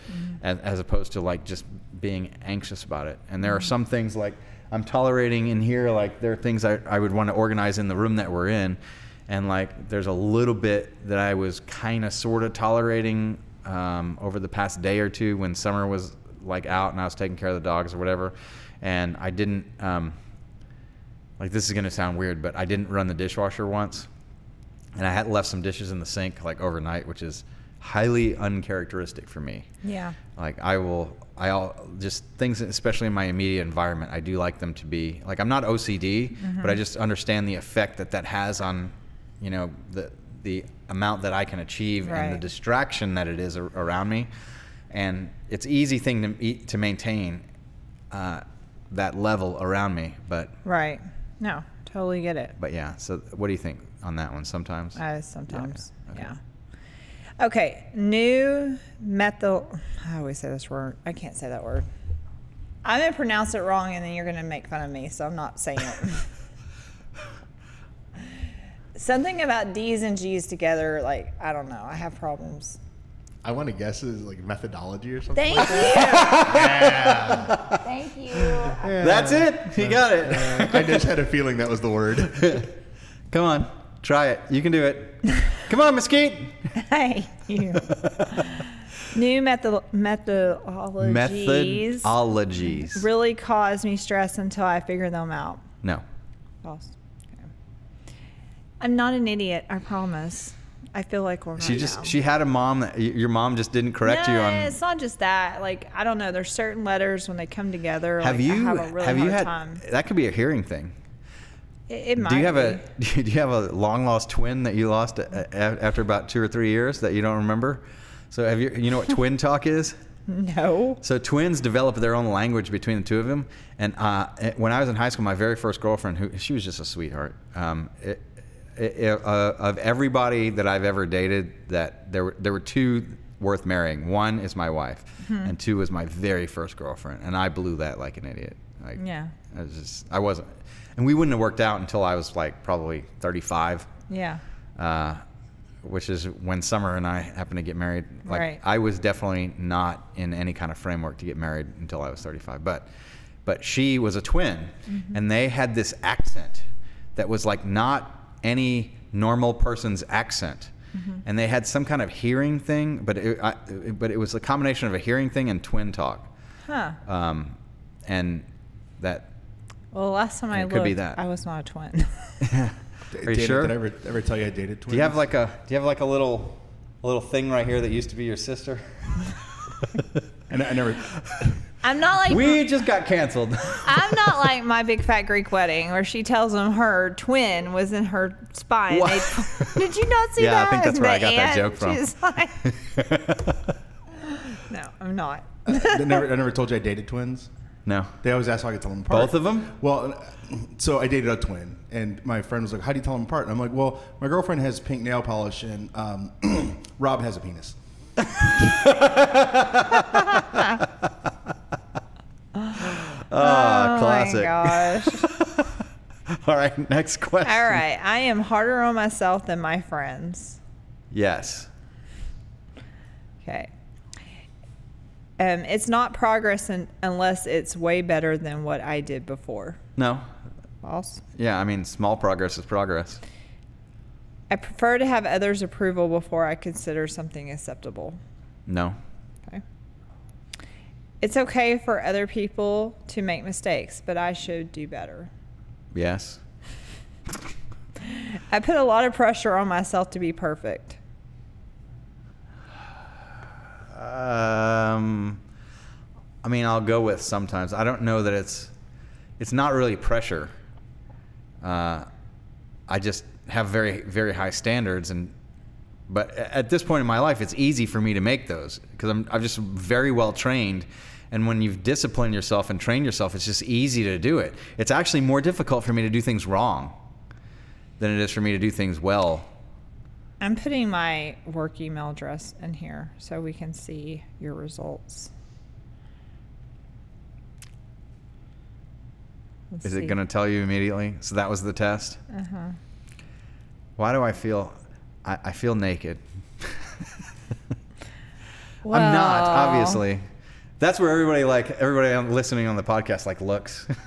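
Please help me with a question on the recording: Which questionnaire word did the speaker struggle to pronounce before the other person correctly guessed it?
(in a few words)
methodology.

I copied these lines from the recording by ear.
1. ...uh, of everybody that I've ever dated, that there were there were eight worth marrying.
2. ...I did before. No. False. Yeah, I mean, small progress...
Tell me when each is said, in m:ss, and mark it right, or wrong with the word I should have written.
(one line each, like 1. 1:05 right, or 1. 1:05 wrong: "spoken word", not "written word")
1. 2:09 wrong: "two", not "eight"
2. 3:48 right.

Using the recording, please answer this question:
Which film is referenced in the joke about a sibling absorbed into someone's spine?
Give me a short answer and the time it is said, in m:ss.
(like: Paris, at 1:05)
My Big Fat Greek Wedding, at 3:04.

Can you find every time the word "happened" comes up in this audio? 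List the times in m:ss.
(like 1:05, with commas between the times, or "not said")
2:27.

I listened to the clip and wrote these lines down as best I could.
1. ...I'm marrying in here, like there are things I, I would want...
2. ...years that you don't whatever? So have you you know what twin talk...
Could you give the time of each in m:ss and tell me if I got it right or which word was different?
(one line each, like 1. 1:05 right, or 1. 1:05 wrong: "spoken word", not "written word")
1. 0:04 wrong: "tolerating", not "marrying"
2. 1:56 wrong: "remember", not "whatever".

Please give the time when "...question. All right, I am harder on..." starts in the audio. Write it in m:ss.
3:37.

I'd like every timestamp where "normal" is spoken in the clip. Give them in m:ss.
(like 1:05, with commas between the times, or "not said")
2:39.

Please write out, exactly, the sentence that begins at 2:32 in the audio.
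But but she was a twin, mm -hmm.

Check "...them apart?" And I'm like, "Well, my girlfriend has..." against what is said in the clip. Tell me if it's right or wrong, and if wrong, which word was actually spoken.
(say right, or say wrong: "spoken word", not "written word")
right.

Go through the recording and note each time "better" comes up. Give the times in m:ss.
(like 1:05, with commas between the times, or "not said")
3:48, 4:04.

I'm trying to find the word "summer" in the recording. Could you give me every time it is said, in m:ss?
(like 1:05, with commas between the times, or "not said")
0:15, 2:26.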